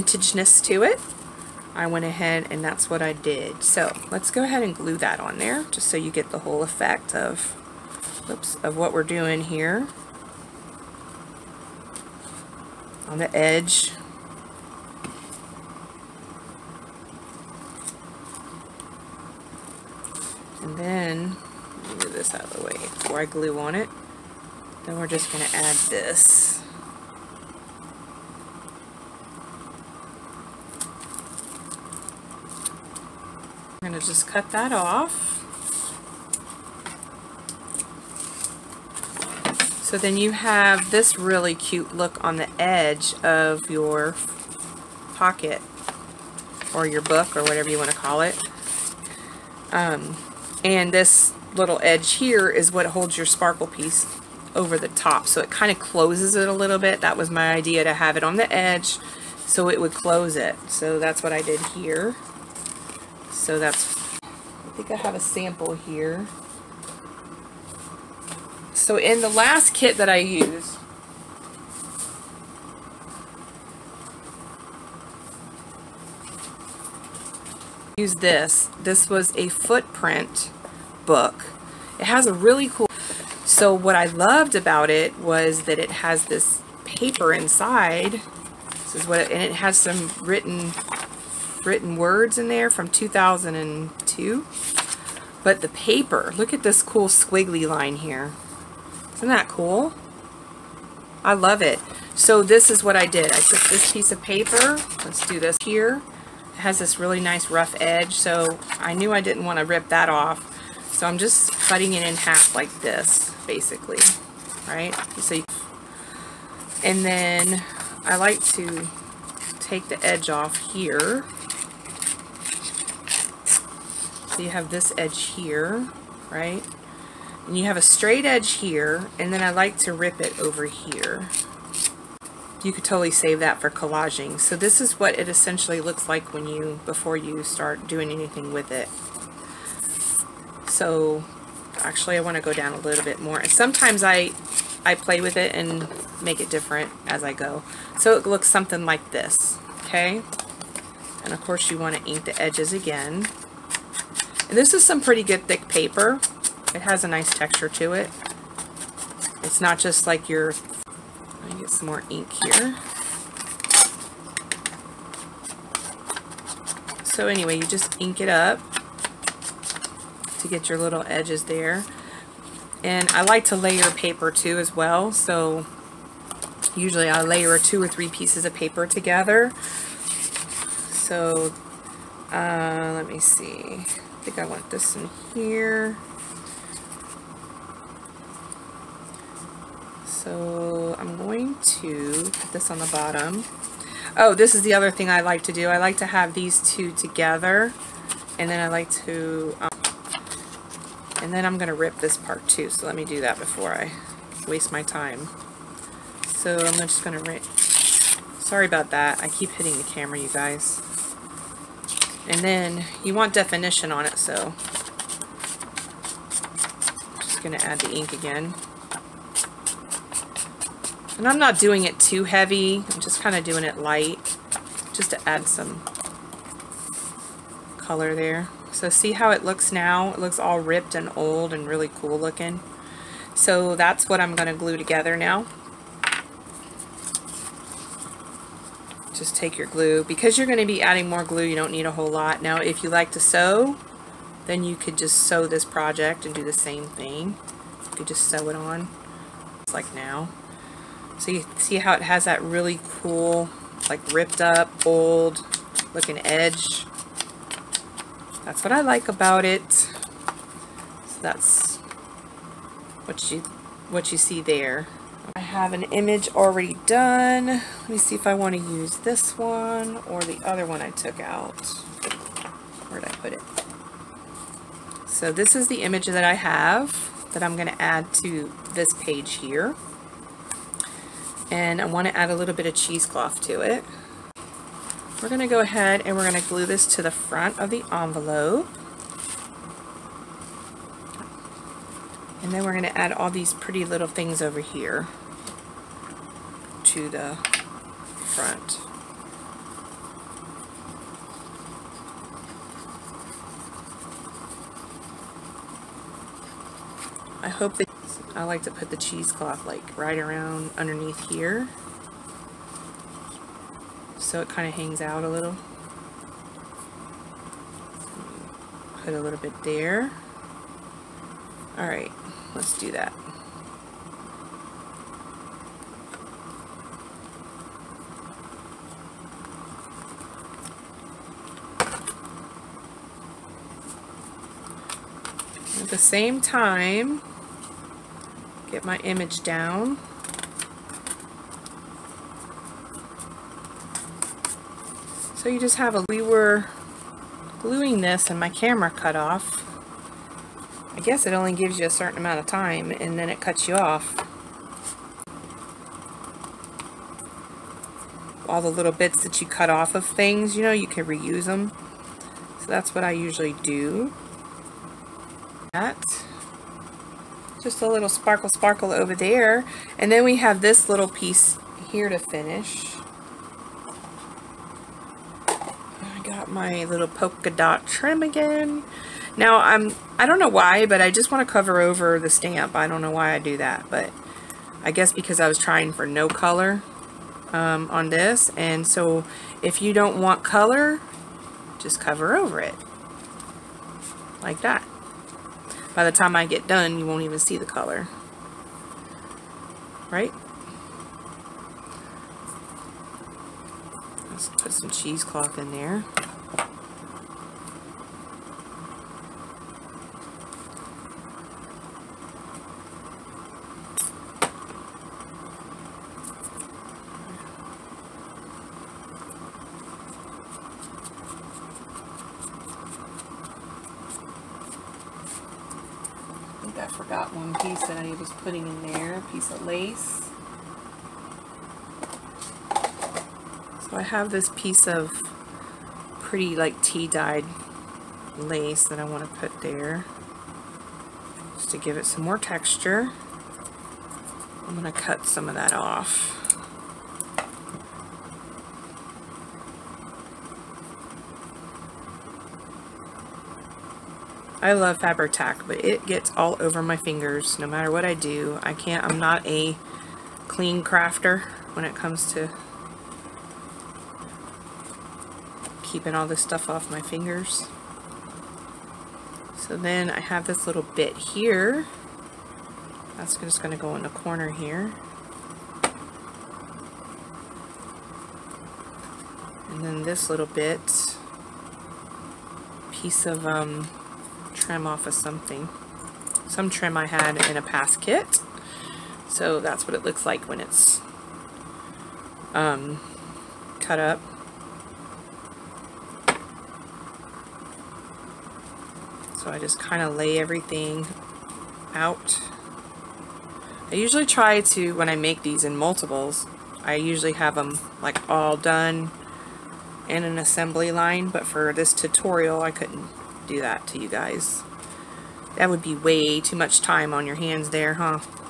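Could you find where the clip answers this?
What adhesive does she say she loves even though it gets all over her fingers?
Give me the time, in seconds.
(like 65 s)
454 s.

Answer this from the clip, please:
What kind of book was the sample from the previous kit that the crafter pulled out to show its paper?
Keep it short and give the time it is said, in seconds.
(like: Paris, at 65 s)
Footprint book, at 79 s.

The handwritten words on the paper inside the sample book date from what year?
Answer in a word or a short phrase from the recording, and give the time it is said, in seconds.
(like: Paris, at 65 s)
2002, at 92 s.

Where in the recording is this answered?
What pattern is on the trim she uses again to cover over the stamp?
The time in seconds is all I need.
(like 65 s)
377 s.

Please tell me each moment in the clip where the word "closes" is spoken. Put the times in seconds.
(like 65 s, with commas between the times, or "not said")
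55 s, 59 s.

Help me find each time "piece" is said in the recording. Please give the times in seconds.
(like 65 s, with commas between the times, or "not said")
53 s, 103 s, 178 s, 371 s, 434 s, 482 s.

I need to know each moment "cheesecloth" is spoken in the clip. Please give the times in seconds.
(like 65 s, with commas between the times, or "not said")
282 s, 308 s, 404 s.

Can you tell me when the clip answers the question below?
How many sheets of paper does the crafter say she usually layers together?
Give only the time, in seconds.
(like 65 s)
177 s.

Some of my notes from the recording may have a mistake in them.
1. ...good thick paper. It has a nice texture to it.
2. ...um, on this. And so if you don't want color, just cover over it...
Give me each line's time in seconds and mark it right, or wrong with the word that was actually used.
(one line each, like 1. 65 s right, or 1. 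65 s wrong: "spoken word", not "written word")
1. 155 s right
2. 387 s right.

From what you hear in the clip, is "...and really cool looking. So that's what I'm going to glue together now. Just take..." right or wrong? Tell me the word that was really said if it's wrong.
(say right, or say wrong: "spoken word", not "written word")
right.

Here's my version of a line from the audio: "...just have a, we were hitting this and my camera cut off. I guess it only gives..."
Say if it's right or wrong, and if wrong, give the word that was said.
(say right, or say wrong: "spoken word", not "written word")
wrong: "gluing", not "hitting".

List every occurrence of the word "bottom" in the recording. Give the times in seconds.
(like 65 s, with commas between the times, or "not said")
192 s.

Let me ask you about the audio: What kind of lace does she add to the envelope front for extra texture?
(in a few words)
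Tea dyed lace.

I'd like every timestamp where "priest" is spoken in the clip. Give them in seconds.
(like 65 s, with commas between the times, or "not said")
not said.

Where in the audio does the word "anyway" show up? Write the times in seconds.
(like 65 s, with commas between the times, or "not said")
167 s.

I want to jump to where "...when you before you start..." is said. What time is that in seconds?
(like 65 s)
136 s.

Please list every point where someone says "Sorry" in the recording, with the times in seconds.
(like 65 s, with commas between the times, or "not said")
208 s.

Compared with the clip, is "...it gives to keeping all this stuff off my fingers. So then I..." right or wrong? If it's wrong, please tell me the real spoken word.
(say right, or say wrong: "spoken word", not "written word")
wrong: "comes", not "gives".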